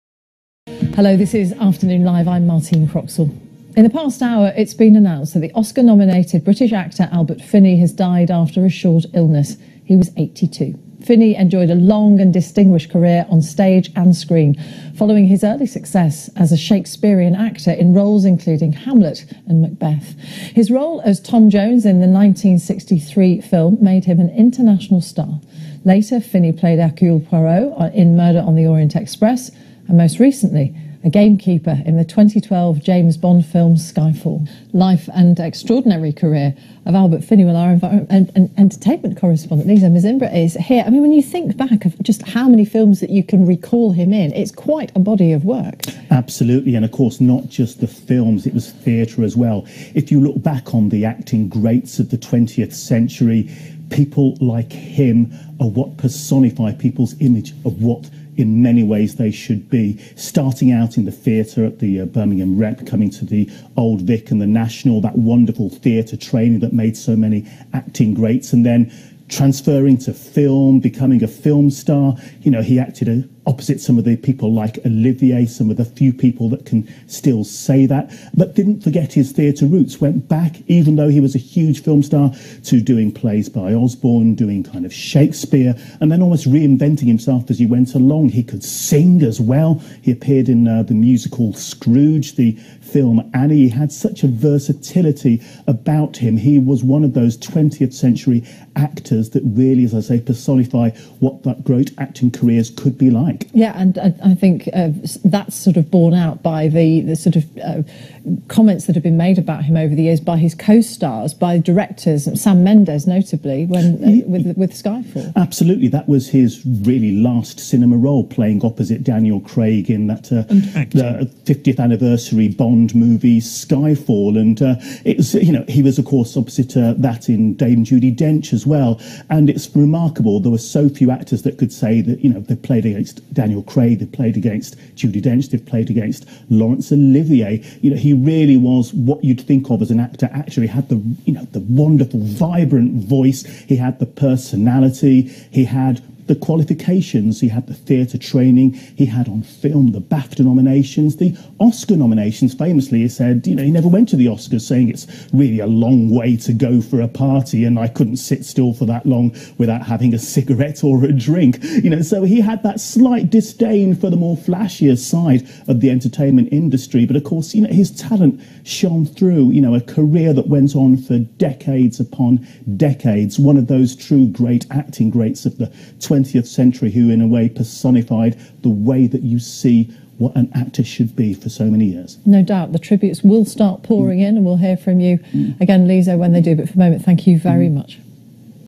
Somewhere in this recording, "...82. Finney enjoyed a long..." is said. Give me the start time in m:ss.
0:10.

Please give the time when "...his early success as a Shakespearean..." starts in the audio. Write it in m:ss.
0:15.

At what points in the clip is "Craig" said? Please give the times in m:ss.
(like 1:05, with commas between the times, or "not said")
1:59, 2:13.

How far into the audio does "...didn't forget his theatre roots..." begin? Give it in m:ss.
1:18.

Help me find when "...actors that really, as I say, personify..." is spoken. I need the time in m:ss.
1:38.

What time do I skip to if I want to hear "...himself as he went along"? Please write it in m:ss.
1:27.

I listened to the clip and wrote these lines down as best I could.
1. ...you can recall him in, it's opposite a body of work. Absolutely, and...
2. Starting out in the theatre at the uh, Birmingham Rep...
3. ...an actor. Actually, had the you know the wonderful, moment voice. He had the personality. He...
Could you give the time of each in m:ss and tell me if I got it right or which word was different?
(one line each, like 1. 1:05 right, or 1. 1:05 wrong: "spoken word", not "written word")
1. 0:43 wrong: "quite", not "opposite"
2. 1:00 right
3. 2:19 wrong: "vibrant", not "moment".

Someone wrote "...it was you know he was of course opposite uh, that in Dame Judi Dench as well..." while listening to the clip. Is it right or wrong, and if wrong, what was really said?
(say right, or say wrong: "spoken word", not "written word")
right.